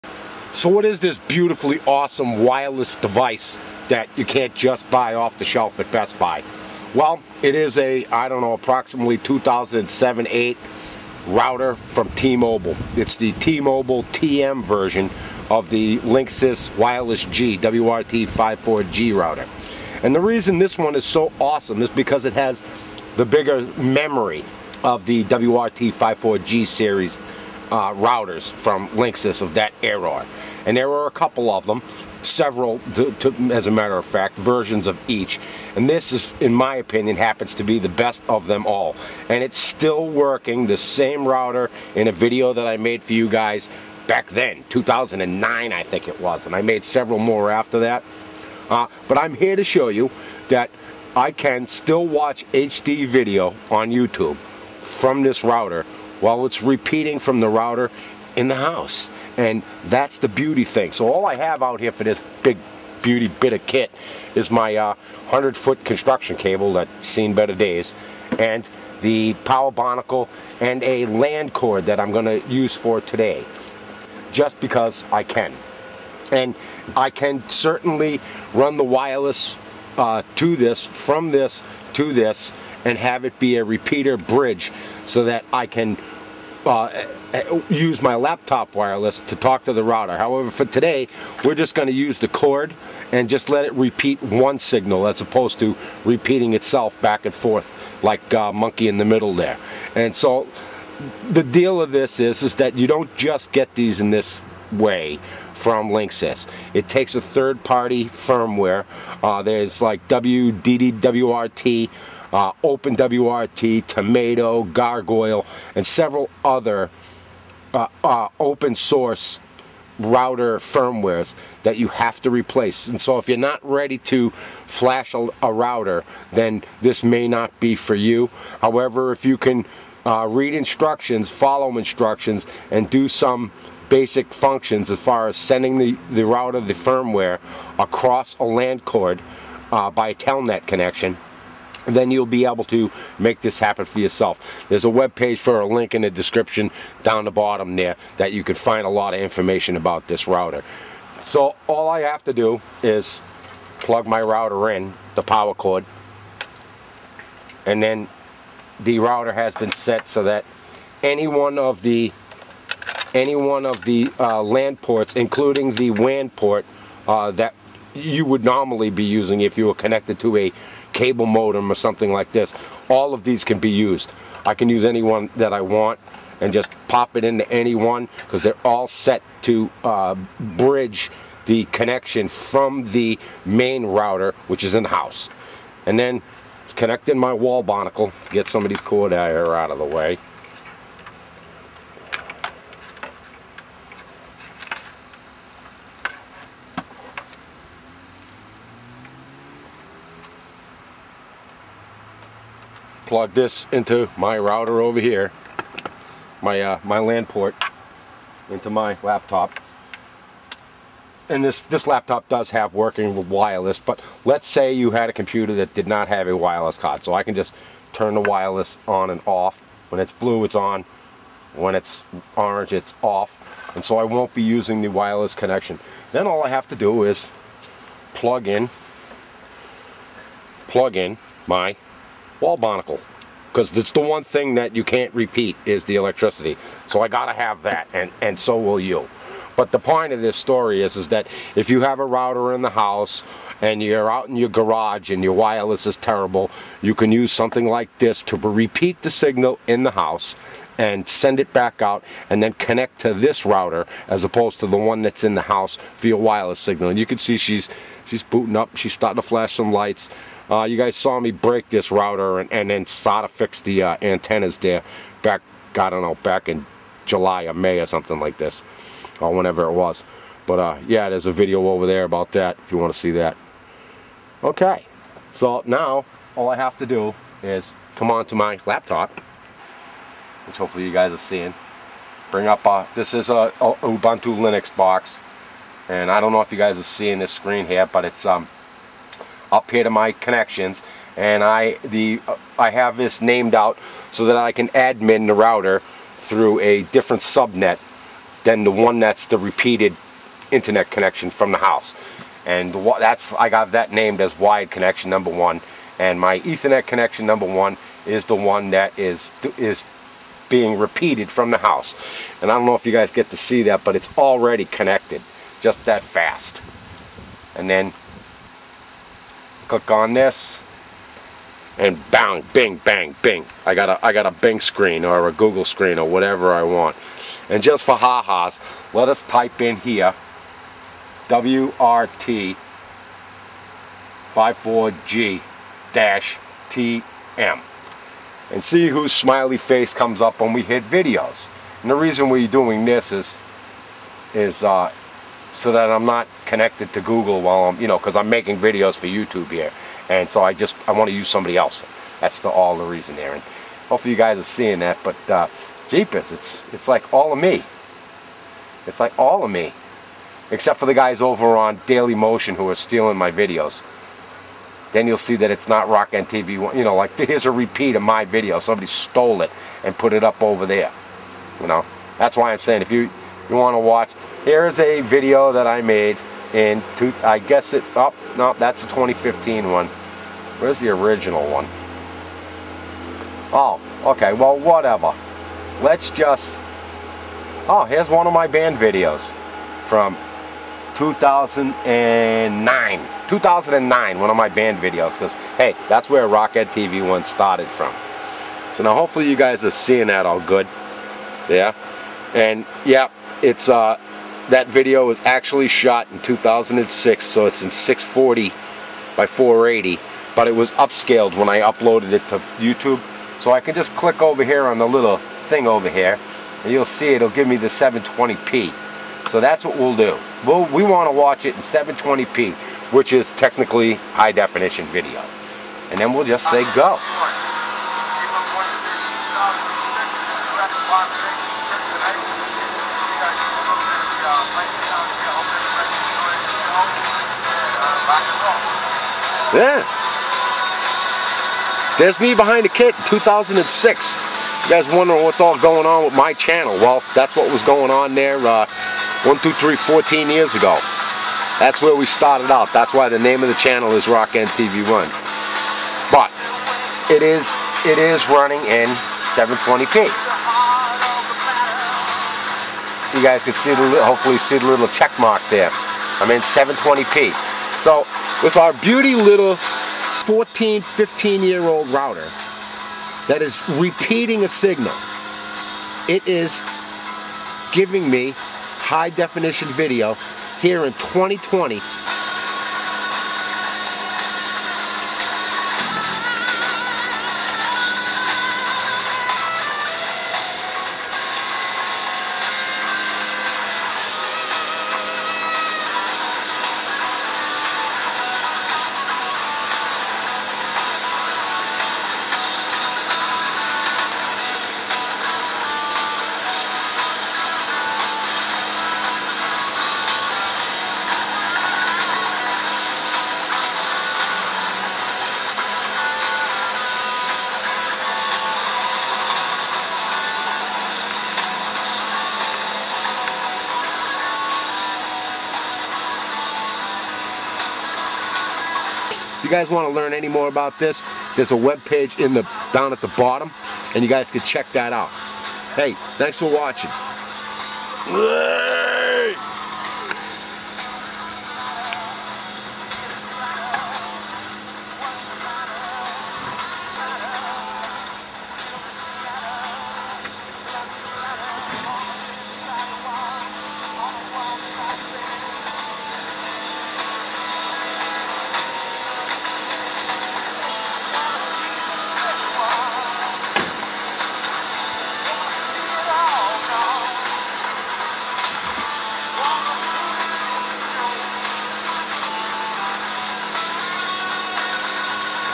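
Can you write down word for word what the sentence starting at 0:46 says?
And I made several more after that.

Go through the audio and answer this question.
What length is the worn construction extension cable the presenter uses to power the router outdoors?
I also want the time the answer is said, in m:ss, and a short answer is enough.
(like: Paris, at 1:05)
100-foot, at 1:05.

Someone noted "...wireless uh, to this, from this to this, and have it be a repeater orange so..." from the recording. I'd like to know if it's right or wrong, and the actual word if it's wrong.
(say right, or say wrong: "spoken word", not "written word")
wrong: "bridge", not "orange".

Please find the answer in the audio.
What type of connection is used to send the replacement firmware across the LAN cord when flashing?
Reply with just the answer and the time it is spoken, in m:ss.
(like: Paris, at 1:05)
telnet, at 2:20.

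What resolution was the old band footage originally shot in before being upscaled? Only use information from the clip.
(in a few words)
640 by 480.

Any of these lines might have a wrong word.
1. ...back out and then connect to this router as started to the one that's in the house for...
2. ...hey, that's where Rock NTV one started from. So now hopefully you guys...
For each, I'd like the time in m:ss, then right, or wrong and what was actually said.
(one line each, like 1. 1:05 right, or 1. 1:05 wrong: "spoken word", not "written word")
1. 4:11 wrong: "opposed", not "started"
2. 6:35 right.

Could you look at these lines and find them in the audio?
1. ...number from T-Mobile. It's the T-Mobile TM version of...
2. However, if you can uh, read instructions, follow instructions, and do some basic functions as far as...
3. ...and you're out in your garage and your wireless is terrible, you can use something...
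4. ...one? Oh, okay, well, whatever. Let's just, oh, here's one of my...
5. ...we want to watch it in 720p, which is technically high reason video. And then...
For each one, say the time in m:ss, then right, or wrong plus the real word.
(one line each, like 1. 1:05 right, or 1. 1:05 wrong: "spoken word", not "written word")
1. 0:11 wrong: "router", not "number"
2. 2:08 right
3. 4:03 right
4. 6:21 right
5. 7:00 wrong: "definition", not "reason".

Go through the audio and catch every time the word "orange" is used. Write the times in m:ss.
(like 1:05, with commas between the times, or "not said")
3:42.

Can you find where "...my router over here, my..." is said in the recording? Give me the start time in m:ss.
3:24.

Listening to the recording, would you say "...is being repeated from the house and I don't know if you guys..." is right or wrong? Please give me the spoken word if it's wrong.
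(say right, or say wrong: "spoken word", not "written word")
right.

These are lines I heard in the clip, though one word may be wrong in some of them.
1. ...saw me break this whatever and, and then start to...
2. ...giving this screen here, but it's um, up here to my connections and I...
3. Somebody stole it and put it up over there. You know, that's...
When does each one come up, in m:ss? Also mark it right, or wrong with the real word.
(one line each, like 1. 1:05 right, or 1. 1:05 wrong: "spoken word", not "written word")
1. 4:20 wrong: "router", not "whatever"
2. 4:46 wrong: "seeing", not "giving"
3. 6:08 right.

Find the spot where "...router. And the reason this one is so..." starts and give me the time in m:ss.
0:19.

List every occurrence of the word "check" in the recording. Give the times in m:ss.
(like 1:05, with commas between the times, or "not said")
7:44, 8:54.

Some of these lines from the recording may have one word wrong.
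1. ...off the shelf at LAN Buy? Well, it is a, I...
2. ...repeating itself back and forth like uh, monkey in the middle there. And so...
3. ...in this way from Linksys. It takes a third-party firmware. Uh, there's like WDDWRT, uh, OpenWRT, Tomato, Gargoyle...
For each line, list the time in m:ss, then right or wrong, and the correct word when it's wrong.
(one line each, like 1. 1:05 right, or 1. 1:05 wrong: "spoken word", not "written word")
1. 0:05 wrong: "Best", not "LAN"
2. 1:36 right
3. 1:43 right.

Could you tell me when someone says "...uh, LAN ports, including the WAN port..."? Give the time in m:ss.
2:44.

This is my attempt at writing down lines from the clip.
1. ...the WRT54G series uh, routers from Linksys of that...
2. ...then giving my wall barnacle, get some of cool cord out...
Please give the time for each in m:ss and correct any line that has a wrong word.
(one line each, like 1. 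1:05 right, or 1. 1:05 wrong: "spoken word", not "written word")
1. 0:25 right
2. 3:05 wrong: "connecting", not "giving".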